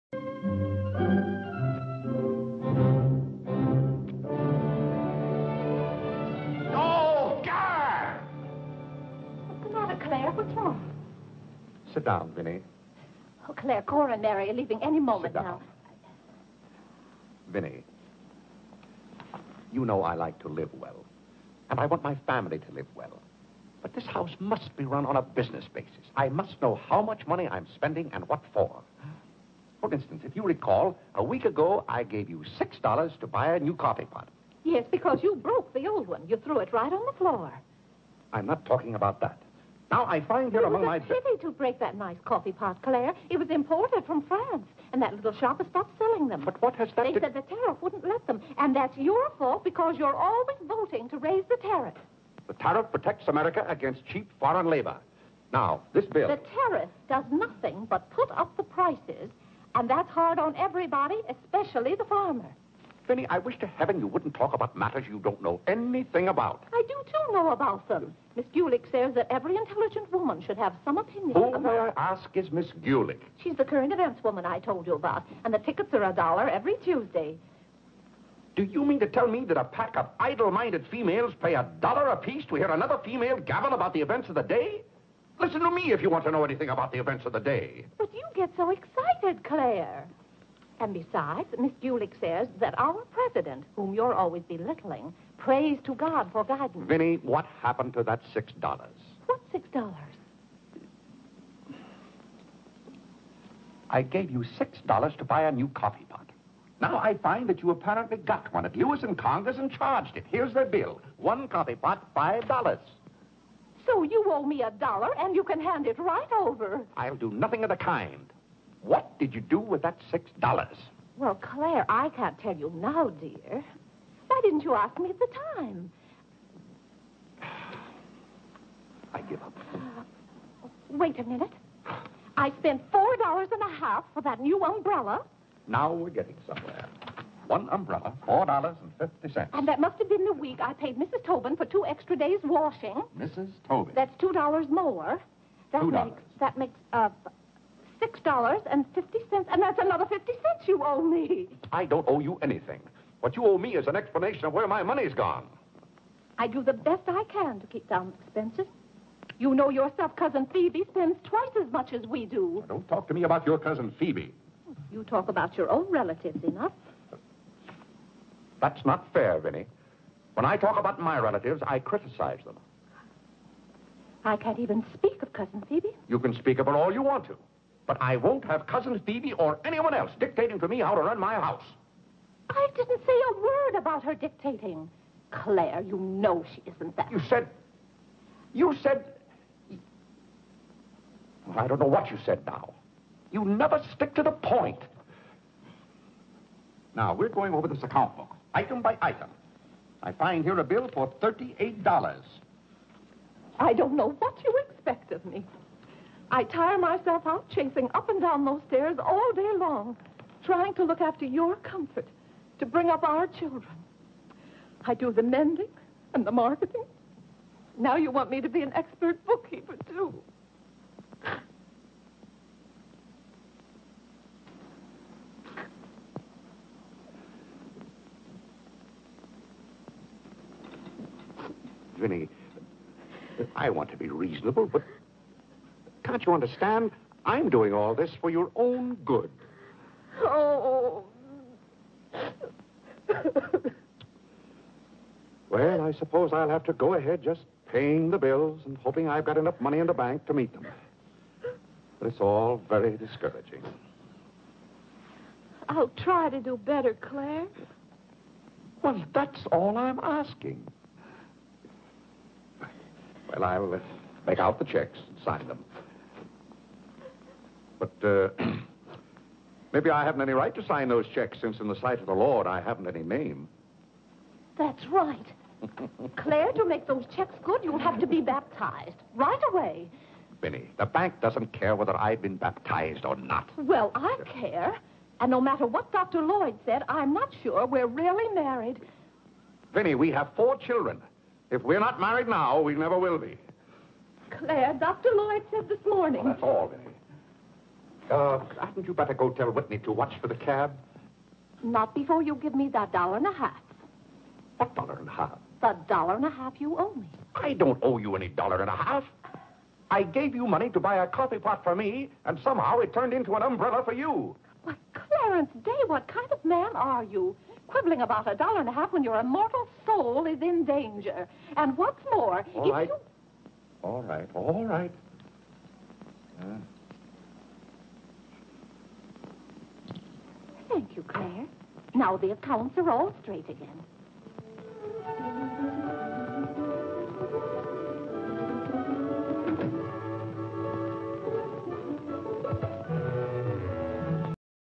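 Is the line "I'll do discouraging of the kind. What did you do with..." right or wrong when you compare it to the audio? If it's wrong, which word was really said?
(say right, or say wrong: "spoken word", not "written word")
wrong: "nothing", not "discouraging".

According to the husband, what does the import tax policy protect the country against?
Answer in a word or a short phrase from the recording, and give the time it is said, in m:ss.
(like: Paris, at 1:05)
cheap foreign labor, at 0:54.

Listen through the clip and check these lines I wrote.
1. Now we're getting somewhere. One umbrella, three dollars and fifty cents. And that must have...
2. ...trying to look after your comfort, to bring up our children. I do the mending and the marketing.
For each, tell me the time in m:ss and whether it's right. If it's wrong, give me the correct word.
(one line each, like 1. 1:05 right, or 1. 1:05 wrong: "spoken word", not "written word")
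1. 2:15 wrong: "four", not "three"
2. 3:30 right.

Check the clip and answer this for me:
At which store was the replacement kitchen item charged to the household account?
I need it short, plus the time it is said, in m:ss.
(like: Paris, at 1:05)
Lewis and Conger, at 1:48.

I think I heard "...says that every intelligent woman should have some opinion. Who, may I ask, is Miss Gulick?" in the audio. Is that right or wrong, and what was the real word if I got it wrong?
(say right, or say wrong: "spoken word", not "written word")
right.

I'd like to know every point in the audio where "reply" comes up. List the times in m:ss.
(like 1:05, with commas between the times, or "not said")
not said.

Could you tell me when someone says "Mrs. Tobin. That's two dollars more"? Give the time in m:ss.
2:23.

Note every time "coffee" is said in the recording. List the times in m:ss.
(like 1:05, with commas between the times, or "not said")
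0:33, 0:42, 1:45, 1:51, 5:11.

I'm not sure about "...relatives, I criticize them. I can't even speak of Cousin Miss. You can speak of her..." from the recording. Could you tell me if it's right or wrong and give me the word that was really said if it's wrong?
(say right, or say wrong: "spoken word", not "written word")
wrong: "Phoebe", not "Miss".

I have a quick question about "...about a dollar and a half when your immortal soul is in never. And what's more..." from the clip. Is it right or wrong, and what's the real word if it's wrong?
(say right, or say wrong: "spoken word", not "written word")
wrong: "danger", not "never".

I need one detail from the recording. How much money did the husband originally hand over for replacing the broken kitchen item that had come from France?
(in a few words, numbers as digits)
$6.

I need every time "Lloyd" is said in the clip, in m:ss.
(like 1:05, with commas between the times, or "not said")
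4:46, 4:55.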